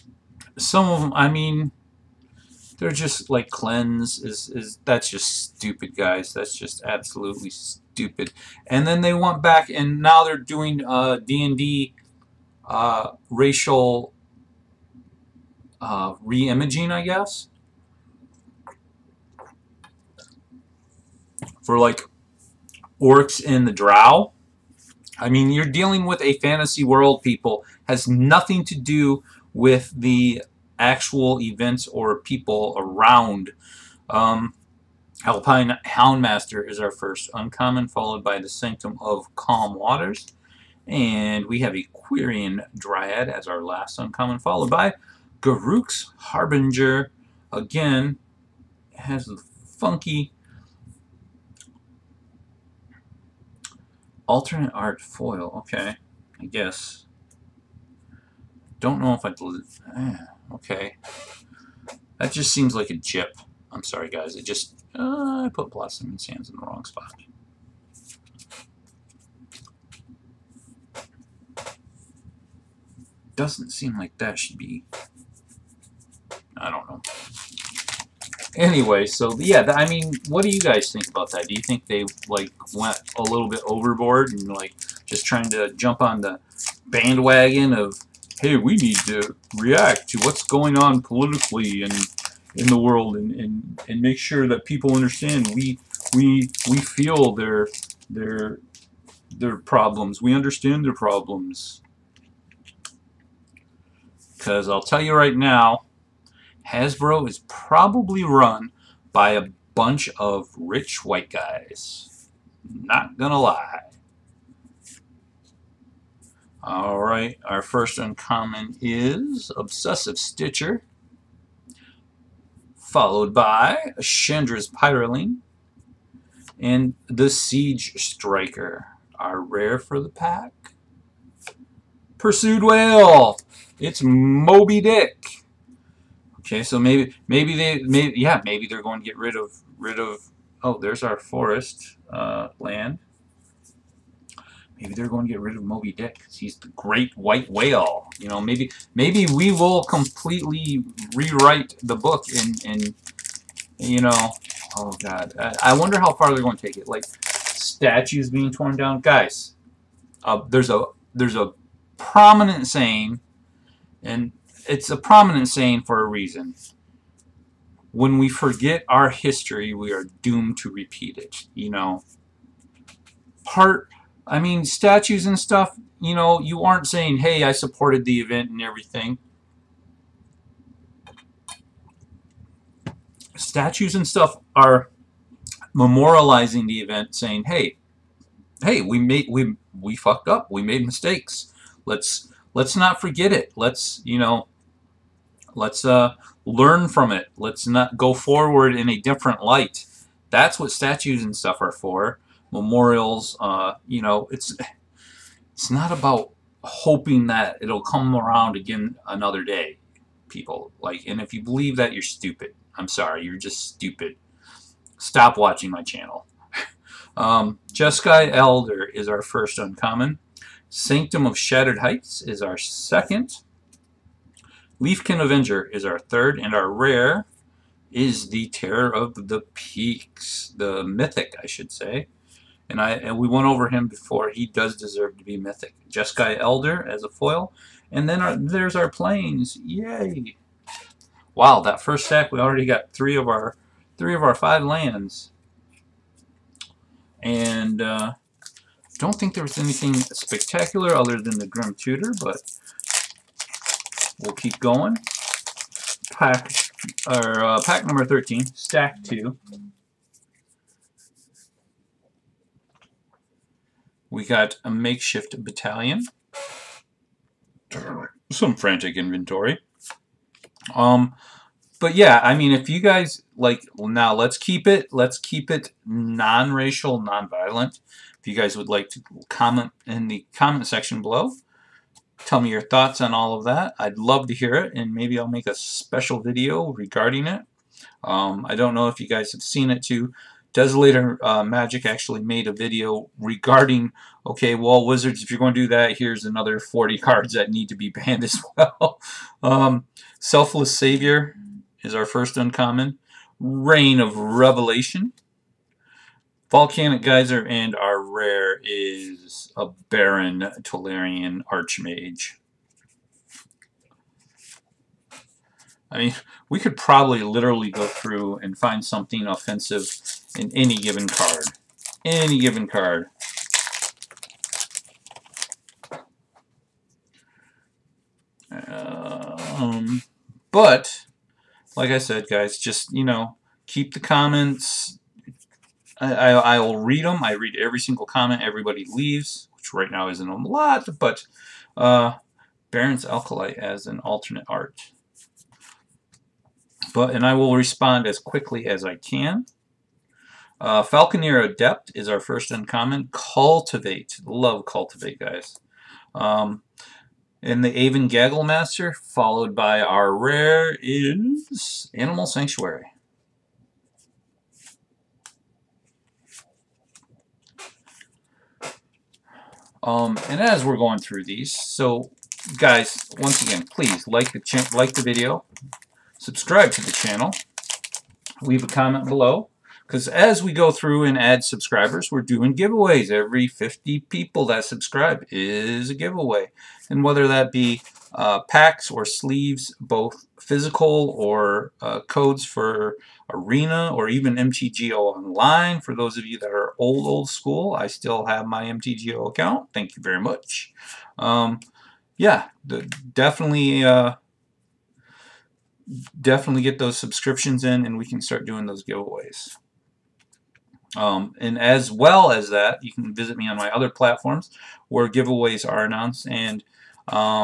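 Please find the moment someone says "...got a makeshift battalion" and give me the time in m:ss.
4:24.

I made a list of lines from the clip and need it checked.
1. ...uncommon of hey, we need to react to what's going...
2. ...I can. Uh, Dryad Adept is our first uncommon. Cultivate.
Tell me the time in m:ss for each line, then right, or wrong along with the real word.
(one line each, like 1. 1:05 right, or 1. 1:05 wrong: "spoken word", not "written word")
1. 1:26 wrong: "bandwagon", not "uncommon"
2. 5:48 wrong: "Falconer", not "Dryad".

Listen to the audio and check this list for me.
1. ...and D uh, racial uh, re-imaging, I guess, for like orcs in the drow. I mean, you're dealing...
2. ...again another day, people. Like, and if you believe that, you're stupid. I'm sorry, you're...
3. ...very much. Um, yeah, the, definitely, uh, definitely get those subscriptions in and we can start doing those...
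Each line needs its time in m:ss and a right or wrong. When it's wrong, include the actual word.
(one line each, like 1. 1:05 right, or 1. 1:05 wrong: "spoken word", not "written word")
1. 0:11 right
2. 3:28 right
3. 6:40 right.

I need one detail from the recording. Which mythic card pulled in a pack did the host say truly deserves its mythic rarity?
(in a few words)
Terror of the Peaks.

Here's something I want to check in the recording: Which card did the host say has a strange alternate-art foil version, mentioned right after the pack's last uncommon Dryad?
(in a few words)
Garruk's Harbinger.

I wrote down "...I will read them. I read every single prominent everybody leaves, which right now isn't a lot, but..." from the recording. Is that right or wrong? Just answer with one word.
wrong.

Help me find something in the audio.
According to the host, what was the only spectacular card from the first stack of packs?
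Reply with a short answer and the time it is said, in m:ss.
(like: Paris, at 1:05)
Grim Tutor, at 4:11.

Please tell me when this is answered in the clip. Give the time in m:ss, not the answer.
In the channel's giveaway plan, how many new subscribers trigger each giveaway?
6:23.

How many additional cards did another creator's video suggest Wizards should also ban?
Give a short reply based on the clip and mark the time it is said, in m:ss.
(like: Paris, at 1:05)
40, at 4:56.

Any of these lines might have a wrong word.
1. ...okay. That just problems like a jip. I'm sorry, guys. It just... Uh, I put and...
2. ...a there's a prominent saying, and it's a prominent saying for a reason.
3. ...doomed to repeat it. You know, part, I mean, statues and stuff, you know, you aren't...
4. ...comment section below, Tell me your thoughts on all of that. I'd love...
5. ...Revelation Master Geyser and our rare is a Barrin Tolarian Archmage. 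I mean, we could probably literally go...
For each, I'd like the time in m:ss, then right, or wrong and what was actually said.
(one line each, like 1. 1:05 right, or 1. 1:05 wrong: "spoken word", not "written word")
1. 1:00 wrong: "seems", not "problems"
2. 2:40 right
3. 2:50 right
4. 4:40 right
5. 5:04 wrong: "Volcanic", not "Master".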